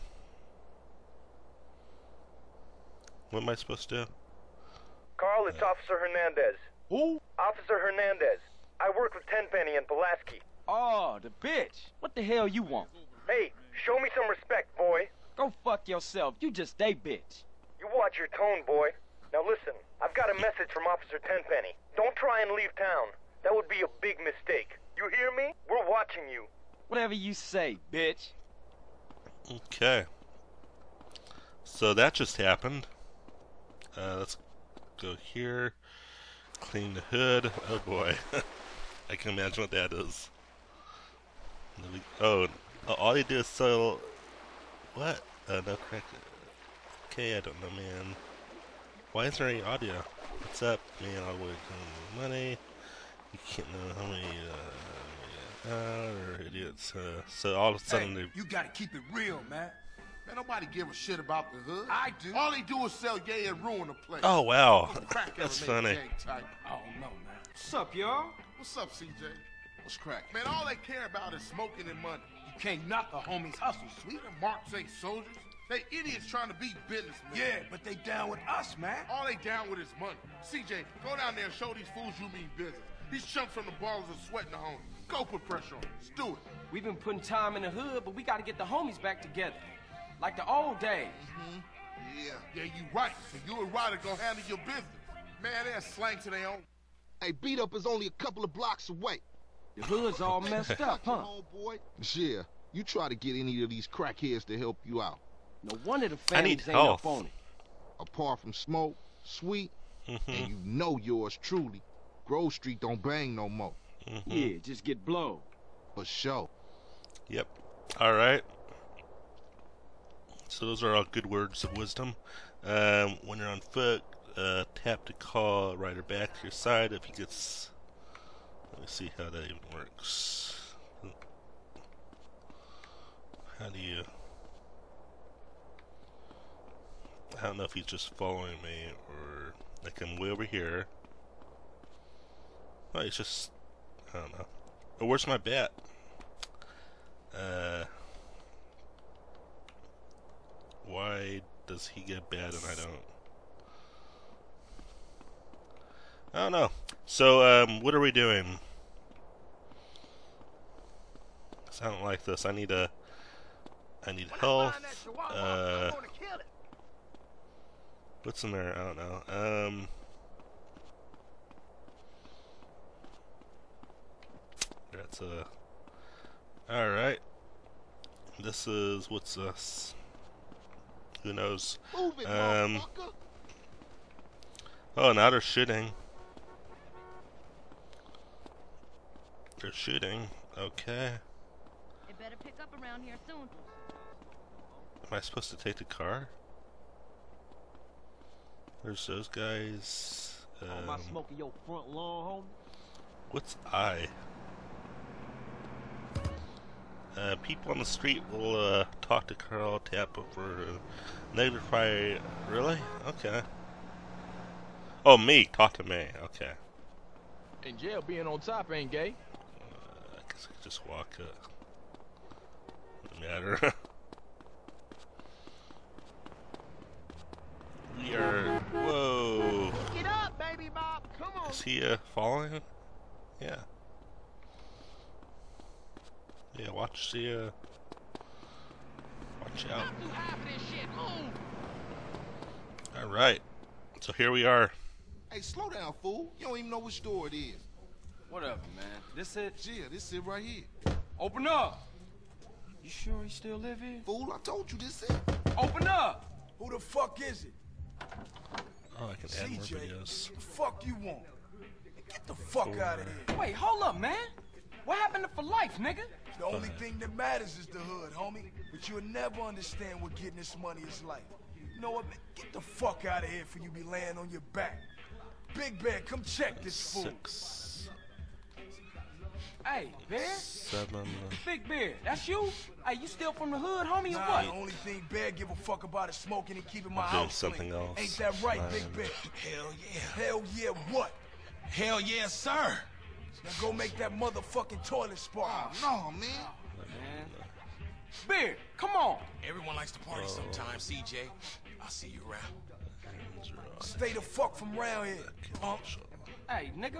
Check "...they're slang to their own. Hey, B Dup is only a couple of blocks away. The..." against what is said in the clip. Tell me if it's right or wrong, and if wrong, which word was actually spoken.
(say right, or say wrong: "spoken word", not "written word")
right.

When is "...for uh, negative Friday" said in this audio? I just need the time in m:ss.
3:30.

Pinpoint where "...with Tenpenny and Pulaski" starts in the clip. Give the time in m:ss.
0:09.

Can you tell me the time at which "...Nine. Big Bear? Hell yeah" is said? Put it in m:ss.
4:48.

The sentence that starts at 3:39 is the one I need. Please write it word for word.
Uh, I guess I could just walk up matter.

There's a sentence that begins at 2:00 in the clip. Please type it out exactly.
So those are all good words of wisdom.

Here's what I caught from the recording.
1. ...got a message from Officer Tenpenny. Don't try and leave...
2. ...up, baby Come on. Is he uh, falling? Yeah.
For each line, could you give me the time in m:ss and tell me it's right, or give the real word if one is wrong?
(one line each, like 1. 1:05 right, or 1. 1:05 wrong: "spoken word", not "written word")
1. 0:20 right
2. 3:50 right.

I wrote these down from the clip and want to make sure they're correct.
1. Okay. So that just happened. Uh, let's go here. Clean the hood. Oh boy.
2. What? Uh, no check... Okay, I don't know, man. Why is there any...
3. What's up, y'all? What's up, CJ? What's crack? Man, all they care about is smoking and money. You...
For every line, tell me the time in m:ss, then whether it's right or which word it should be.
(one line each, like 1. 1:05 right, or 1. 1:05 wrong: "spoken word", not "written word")
1. 0:29 right
2. 0:44 wrong: "crack", not "check"
3. 1:07 right.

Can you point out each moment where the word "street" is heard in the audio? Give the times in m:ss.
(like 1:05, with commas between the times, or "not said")
1:52, 3:27.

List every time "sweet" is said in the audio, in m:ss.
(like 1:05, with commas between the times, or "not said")
1:14, 1:49.